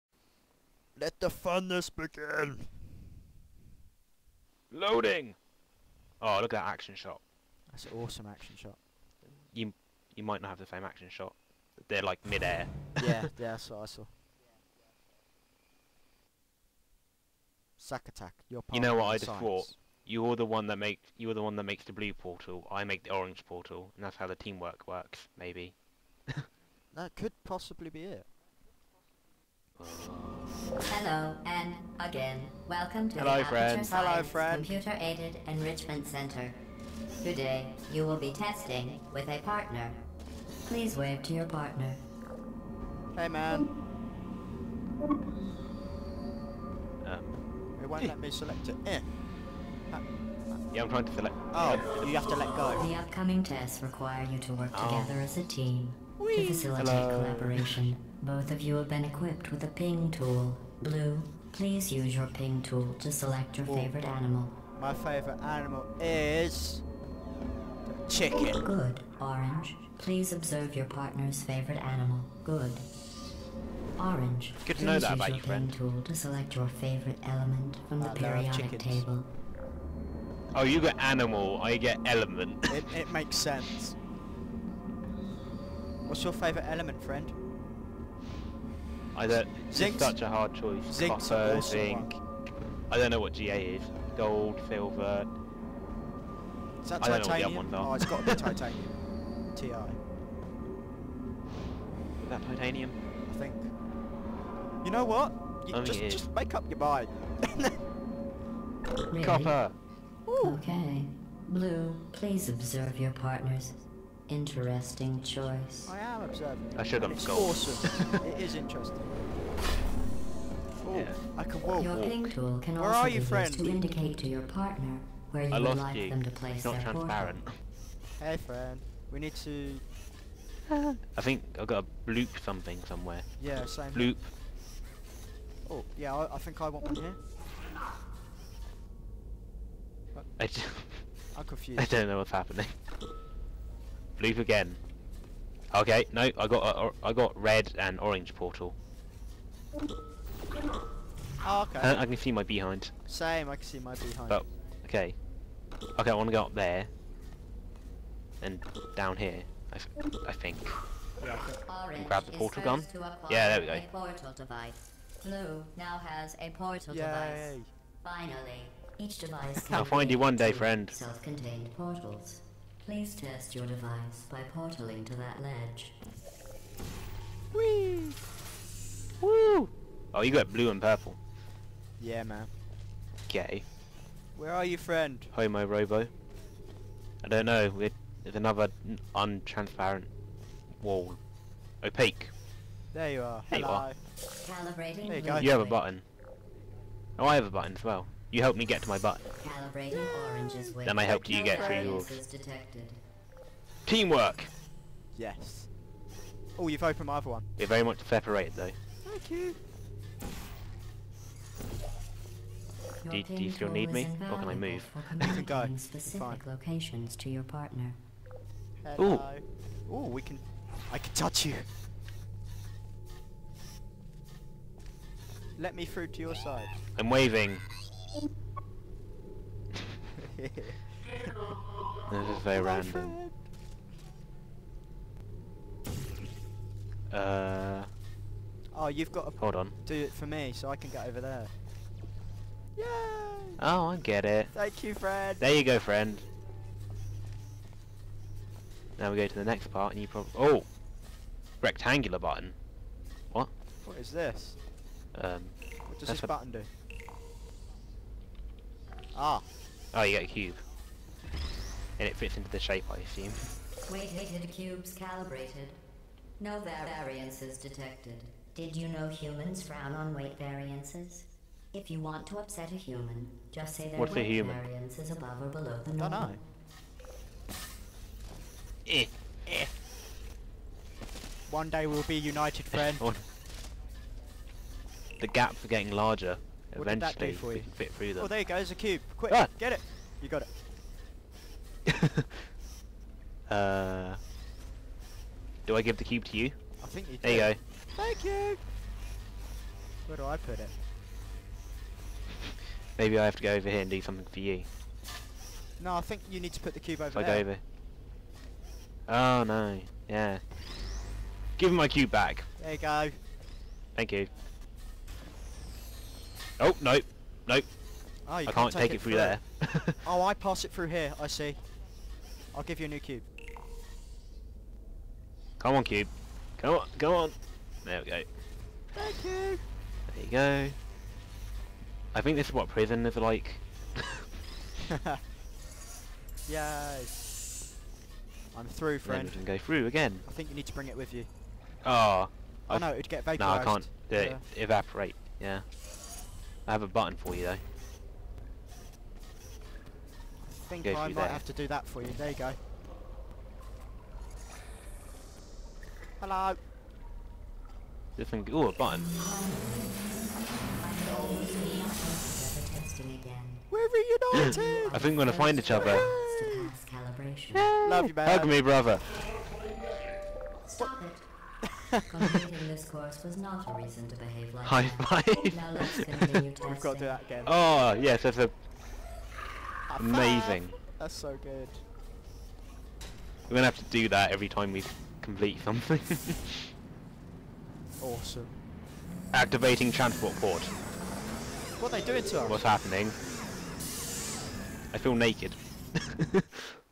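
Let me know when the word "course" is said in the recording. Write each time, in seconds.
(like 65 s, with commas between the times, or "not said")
372 s.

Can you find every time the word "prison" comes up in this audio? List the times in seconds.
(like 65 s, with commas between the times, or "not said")
332 s.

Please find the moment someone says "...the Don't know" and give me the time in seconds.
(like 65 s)
275 s.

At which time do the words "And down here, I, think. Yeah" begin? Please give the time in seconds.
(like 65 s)
158 s.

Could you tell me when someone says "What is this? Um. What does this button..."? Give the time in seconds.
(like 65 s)
253 s.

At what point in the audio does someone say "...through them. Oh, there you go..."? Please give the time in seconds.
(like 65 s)
287 s.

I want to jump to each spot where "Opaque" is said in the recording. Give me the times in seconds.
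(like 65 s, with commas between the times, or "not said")
191 s.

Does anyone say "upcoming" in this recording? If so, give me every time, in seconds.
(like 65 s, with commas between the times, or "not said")
52 s.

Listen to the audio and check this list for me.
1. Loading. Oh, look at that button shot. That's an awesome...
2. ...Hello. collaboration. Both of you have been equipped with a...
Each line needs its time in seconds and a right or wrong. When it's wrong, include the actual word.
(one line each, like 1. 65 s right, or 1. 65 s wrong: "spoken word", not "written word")
1. 4 s wrong: "action", not "button"
2. 56 s right.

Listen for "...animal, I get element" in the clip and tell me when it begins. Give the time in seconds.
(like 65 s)
80 s.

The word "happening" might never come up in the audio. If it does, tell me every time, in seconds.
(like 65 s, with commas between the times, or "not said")
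142 s, 392 s.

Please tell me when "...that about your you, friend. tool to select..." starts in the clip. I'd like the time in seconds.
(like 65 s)
74 s.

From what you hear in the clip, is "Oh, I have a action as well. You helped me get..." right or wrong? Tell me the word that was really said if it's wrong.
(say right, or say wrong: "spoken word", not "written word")
wrong: "button", not "action".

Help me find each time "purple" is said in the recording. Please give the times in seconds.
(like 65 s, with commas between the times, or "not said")
180 s.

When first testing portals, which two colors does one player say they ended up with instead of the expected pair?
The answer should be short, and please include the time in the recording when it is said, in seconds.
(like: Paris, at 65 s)
Red and orange, at 147 s.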